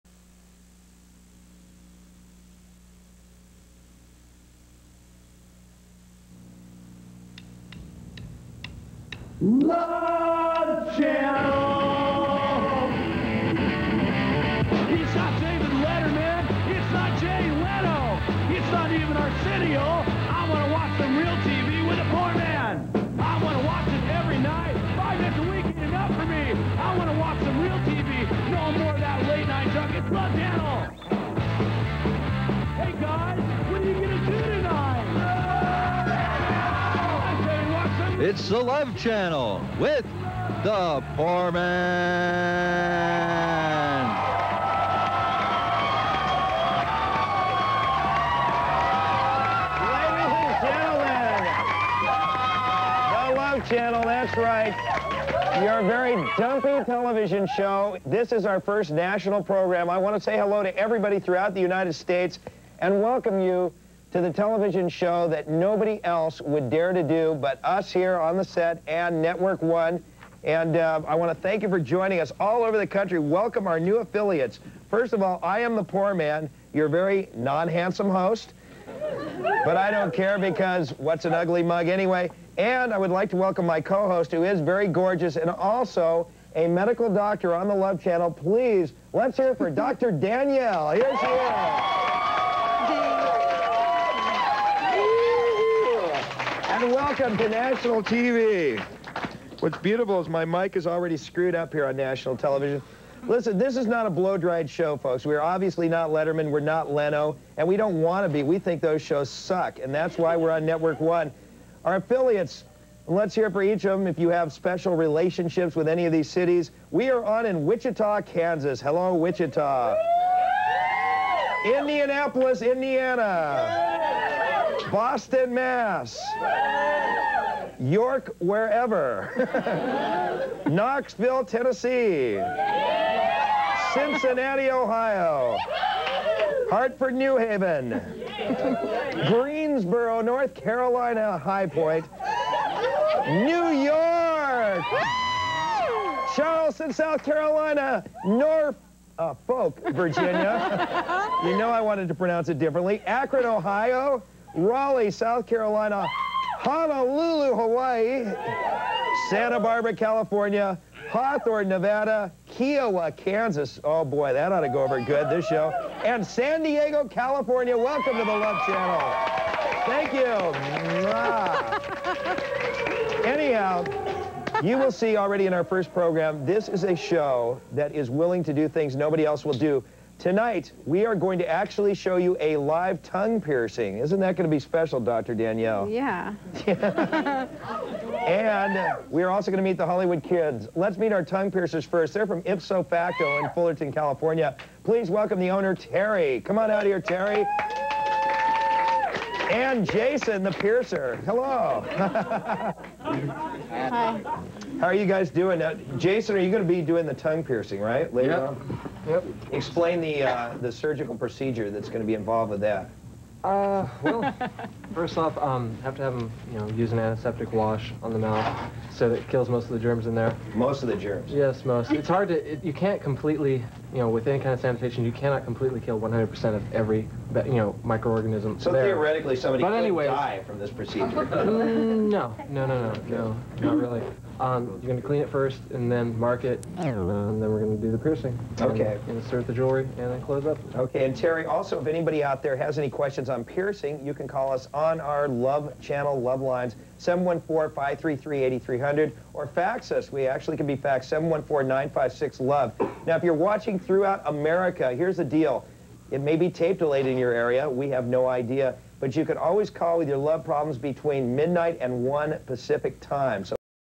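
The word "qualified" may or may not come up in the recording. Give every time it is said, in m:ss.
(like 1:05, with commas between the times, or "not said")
not said.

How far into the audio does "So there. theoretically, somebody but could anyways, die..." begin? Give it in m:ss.
3:48.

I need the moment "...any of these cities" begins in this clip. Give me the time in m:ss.
1:55.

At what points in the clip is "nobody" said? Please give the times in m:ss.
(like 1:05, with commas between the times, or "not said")
1:05, 2:58.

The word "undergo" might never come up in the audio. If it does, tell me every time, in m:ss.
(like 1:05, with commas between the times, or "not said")
not said.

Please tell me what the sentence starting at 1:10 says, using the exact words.
And uh, I want to thank you for joining us all over the country.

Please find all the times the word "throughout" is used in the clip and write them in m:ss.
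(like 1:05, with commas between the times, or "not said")
1:01, 4:13.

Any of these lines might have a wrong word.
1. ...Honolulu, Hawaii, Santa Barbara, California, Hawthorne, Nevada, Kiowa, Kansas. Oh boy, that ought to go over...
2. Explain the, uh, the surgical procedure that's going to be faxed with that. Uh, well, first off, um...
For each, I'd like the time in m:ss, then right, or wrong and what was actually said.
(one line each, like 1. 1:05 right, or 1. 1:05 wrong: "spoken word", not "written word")
1. 2:36 right
2. 3:29 wrong: "involved", not "faxed".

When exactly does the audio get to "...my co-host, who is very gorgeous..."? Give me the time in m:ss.
1:23.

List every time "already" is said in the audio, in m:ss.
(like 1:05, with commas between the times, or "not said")
1:40, 2:55.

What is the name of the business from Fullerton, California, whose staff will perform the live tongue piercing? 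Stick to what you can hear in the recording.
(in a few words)
Ipso Facto.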